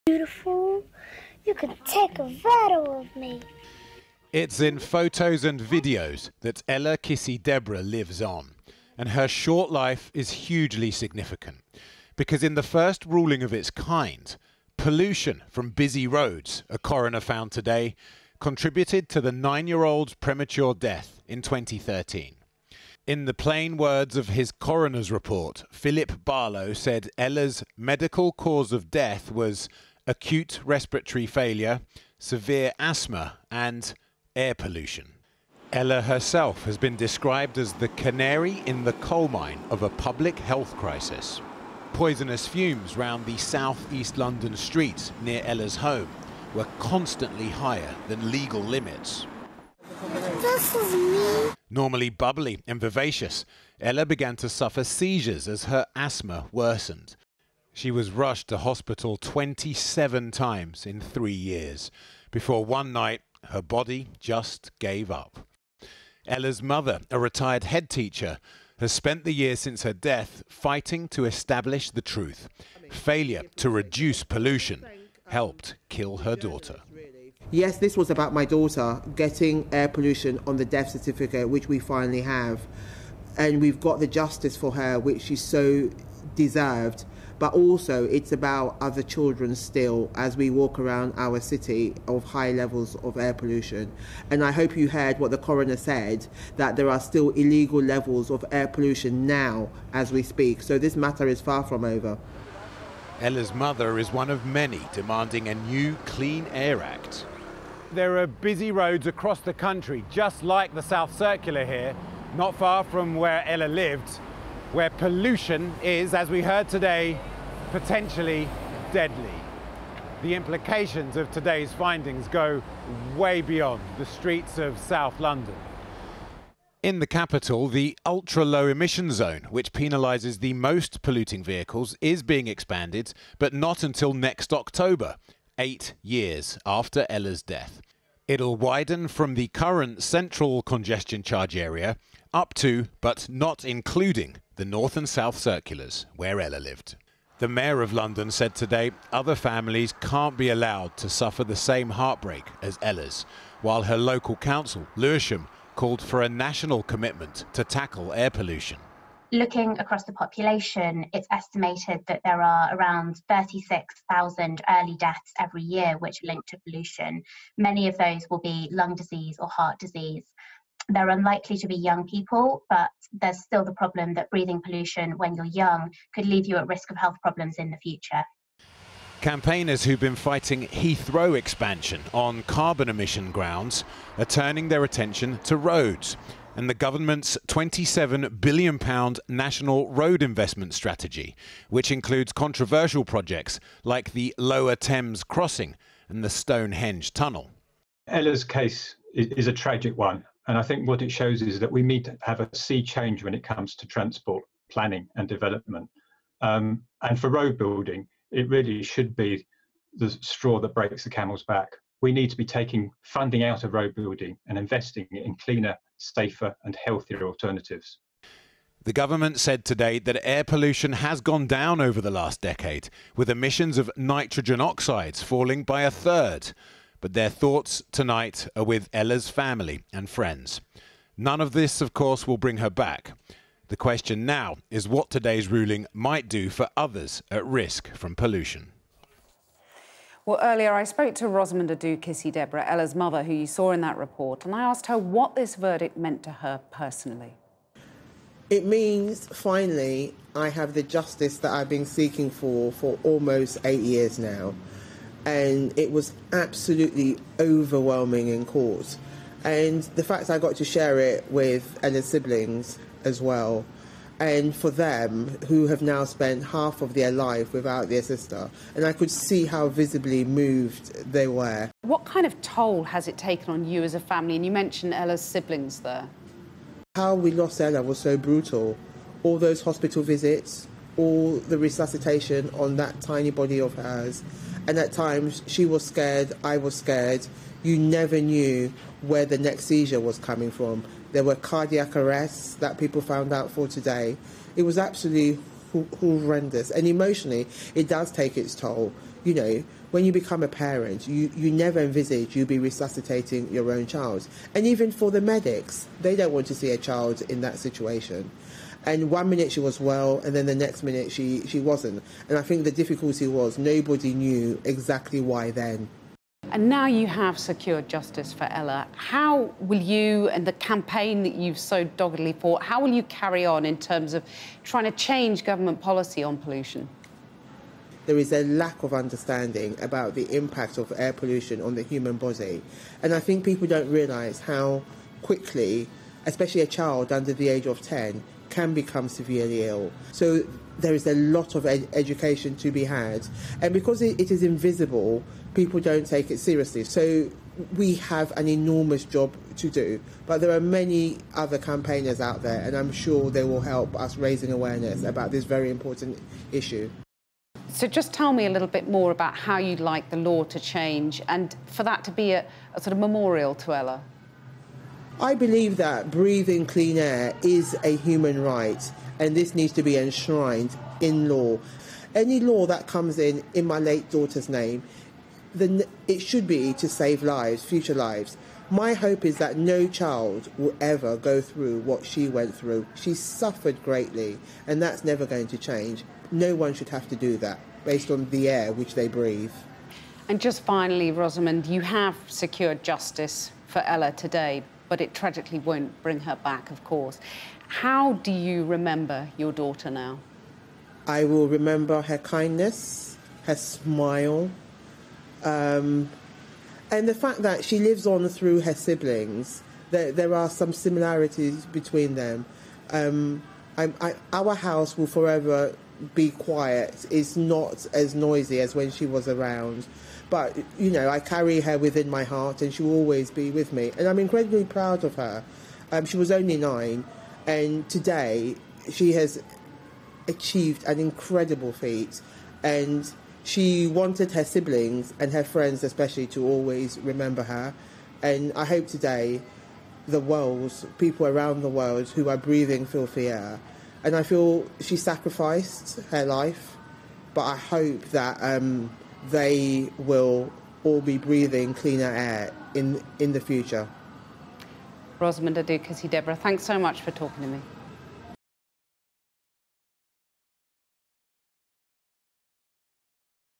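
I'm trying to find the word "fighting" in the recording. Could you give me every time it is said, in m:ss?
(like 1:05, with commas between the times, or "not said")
1:10, 3:00.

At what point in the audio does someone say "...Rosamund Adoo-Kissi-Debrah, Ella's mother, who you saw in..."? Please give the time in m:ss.
4:01.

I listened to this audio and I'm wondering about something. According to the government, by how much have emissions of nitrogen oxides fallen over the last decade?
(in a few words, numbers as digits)
A third.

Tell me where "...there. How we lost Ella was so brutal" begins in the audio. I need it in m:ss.
4:35.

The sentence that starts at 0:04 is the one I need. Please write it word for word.
It's in photos and videos that Ella Kissi-Debrah lives on.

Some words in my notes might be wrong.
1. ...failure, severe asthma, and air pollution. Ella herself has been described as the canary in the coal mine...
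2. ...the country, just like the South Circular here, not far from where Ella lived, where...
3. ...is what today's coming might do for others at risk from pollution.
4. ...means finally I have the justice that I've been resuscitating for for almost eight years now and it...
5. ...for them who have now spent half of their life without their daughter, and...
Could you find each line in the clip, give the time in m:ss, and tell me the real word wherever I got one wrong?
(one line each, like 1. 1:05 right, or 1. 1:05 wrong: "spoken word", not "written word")
1. 0:31 right
2. 1:49 right
3. 3:54 wrong: "ruling", not "coming"
4. 4:08 wrong: "seeking", not "resuscitating"
5. 4:24 wrong: "sister", not "daughter".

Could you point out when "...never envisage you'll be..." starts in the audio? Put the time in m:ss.
5:01.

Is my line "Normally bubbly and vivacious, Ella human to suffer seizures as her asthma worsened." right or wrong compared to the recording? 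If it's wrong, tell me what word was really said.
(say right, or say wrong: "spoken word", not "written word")
wrong: "began", not "human".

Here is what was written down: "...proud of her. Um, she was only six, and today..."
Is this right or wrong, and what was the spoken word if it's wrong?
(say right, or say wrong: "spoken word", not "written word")
wrong: "nine", not "six".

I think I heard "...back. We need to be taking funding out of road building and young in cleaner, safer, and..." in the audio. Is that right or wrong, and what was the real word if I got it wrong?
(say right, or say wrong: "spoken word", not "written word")
wrong: "investing", not "young".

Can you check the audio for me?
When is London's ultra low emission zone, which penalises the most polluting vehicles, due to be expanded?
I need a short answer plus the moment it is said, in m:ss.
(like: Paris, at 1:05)
Next October, at 2:14.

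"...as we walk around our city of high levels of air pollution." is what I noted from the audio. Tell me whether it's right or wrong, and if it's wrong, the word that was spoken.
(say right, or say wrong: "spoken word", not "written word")
right.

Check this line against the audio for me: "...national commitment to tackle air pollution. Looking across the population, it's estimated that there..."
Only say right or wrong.
right.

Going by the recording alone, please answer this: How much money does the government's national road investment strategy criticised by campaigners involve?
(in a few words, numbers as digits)
£27 billion.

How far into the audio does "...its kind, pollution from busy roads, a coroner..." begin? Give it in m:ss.
0:13.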